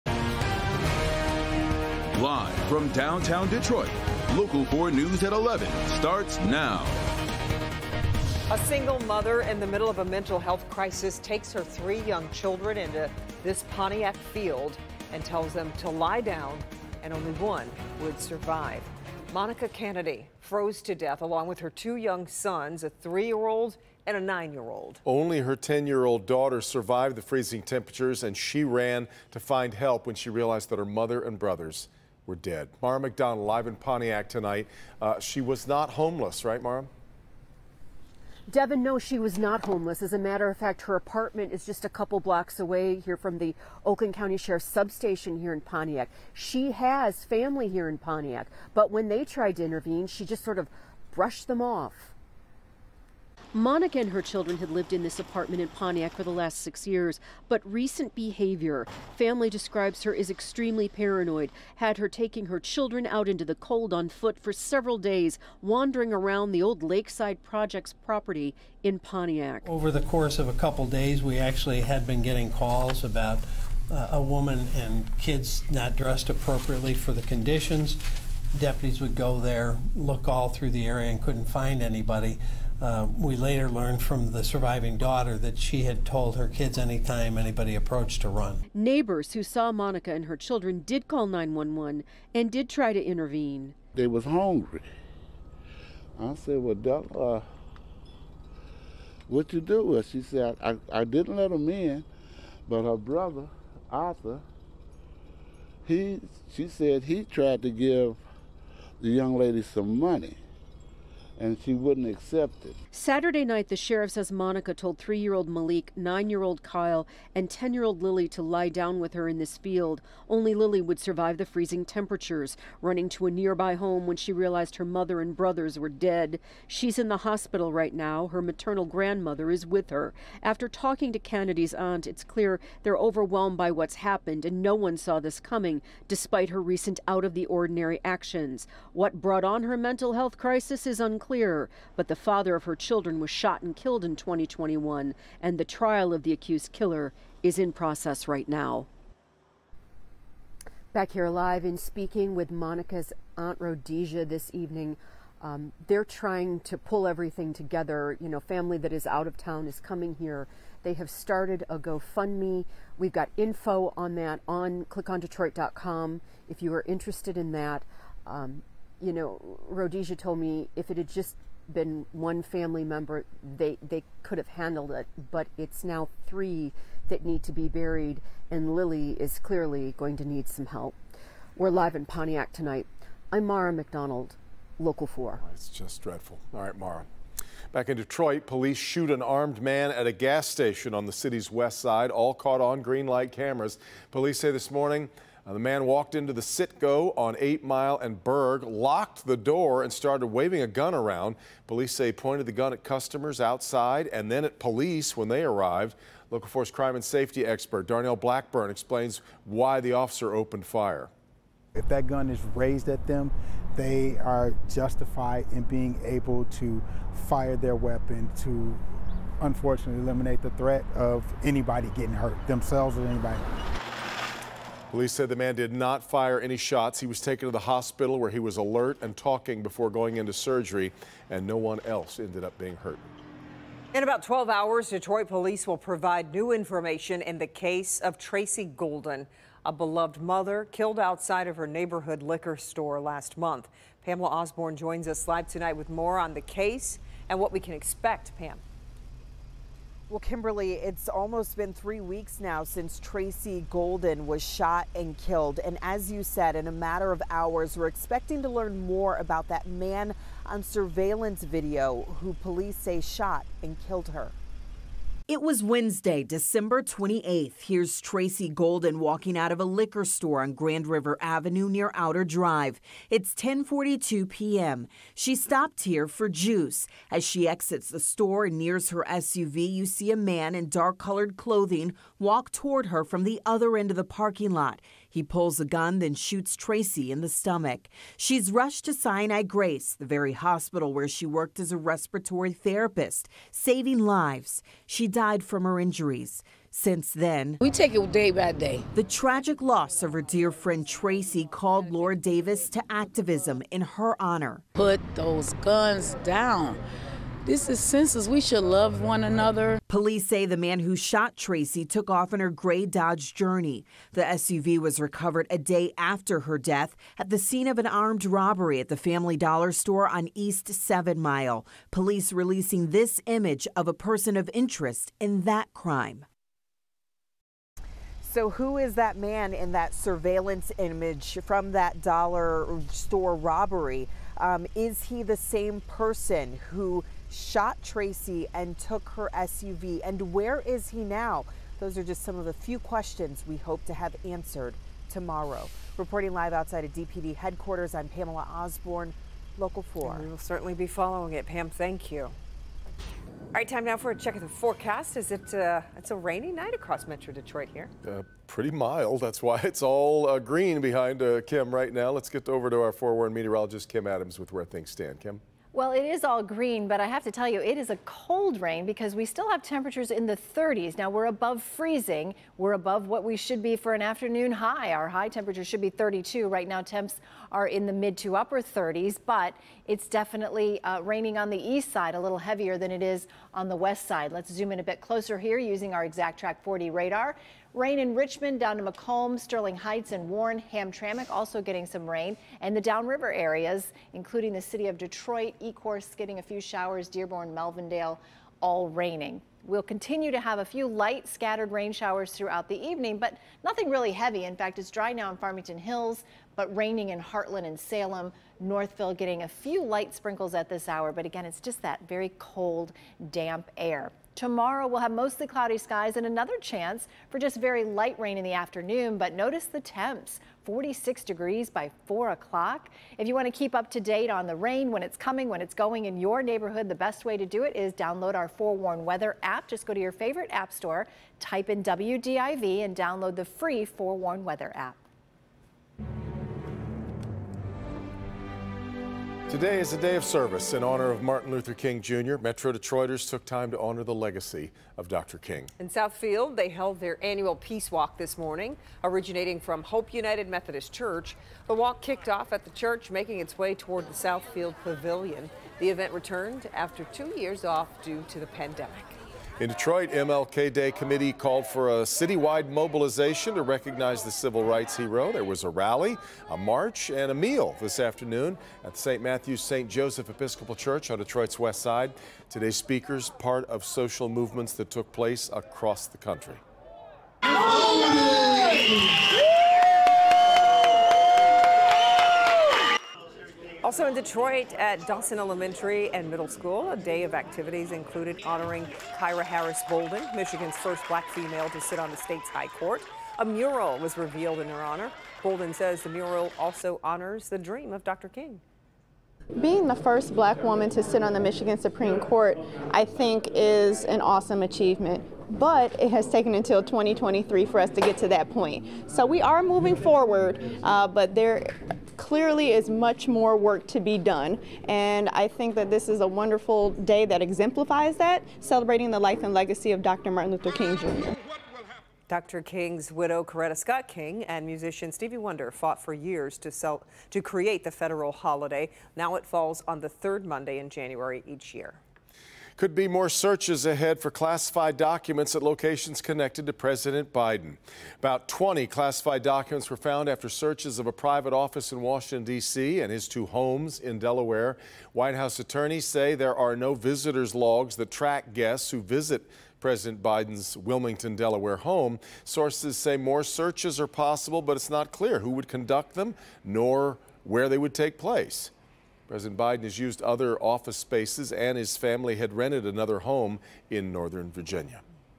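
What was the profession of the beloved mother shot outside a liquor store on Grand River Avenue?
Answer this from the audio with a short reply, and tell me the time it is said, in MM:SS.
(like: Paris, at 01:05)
respiratory therapist, at 04:51.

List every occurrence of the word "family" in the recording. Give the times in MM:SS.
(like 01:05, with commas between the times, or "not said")
00:47, 00:59, 02:38, 02:52, 05:18, 09:21.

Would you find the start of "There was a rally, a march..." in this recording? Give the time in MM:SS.
07:45.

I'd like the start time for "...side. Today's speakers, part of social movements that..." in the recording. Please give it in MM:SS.
07:51.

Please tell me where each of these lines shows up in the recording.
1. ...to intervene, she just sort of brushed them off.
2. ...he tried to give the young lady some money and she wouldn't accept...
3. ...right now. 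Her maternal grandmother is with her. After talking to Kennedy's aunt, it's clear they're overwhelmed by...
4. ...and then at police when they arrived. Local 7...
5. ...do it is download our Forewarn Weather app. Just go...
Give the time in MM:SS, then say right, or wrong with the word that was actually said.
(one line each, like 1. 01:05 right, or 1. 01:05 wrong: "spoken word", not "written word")
1. 00:49 right
2. 01:47 right
3. 02:07 right
4. 03:24 wrong: "4", not "7"
5. 07:07 right.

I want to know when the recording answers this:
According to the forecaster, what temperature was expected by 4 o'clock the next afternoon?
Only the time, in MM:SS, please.
07:00.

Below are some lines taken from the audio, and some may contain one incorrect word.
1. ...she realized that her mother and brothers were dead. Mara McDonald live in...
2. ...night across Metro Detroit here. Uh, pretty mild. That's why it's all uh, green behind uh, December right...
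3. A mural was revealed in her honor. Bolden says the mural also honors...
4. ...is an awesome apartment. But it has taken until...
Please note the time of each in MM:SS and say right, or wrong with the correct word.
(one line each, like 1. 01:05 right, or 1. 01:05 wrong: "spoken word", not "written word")
1. 00:30 right
2. 05:56 wrong: "Kim", not "December"
3. 08:13 right
4. 08:23 wrong: "achievement", not "apartment".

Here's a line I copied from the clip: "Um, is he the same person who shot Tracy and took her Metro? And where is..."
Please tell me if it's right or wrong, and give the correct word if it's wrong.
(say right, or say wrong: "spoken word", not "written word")
wrong: "SUV", not "Metro".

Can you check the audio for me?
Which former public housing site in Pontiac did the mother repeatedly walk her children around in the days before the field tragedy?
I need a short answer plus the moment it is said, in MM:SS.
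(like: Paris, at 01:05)
Lakeside Projects, at 01:06.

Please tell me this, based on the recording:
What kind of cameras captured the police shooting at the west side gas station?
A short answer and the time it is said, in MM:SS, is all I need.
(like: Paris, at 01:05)
green light cameras, at 03:12.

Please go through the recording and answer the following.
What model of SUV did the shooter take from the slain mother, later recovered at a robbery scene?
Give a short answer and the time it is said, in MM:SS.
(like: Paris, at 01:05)
Dodge Journey, at 05:12.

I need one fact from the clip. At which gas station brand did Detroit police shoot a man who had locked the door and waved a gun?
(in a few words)
Citgo.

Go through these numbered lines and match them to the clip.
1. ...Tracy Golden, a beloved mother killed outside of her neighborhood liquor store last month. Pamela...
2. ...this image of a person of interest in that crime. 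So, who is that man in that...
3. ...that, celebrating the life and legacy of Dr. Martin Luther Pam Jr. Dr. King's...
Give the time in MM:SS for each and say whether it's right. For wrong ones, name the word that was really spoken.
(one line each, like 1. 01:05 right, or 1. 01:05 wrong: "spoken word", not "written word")
1. 03:58 right
2. 05:22 right
3. 08:38 wrong: "King", not "Pam".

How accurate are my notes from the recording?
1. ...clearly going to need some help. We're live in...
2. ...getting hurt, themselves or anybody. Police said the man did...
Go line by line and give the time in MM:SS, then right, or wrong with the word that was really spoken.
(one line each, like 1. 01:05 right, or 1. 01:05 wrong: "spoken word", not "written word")
1. 02:59 right
2. 03:41 right.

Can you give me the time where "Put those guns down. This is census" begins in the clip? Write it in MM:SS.
05:04.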